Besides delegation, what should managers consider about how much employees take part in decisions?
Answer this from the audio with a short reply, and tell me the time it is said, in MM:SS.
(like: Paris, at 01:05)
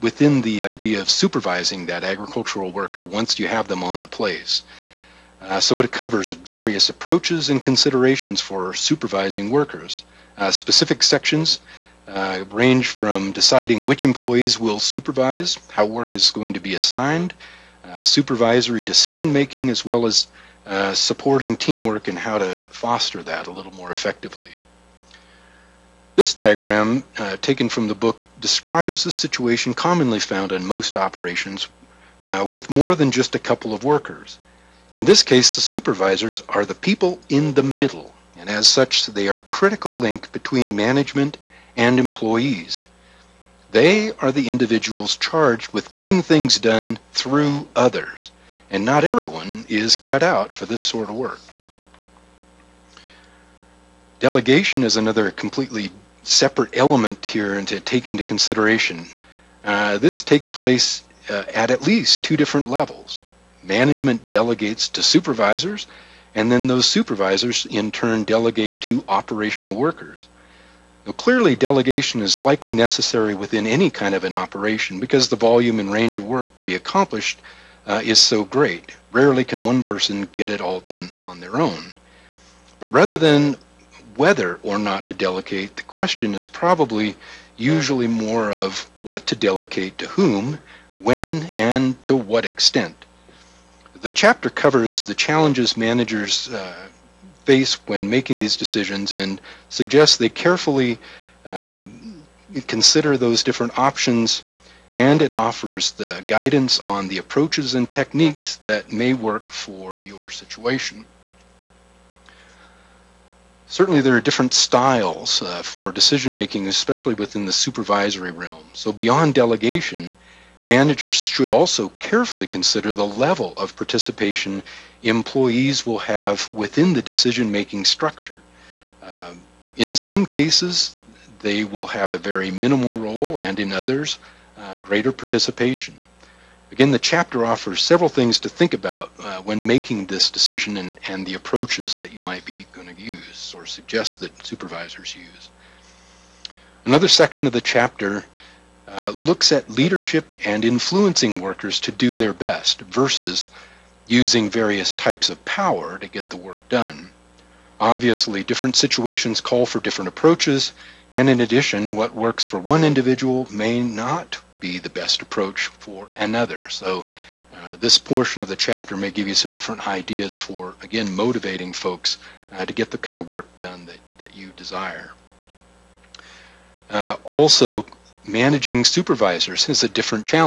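level of participation, at 02:02.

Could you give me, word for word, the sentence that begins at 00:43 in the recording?
They are the individuals charged with getting things done through others, and not everyone is cut out for this sort of work.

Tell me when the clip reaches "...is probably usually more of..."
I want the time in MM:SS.
01:26.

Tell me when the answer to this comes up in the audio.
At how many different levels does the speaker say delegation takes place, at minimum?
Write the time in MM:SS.
01:01.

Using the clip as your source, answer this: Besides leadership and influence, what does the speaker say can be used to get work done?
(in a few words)
various types of power.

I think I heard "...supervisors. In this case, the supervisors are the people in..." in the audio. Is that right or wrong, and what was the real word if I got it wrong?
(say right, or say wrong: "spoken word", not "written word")
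wrong: "workers", not "supervisors".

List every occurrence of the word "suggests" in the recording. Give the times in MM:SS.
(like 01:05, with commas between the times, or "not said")
01:39, 02:23.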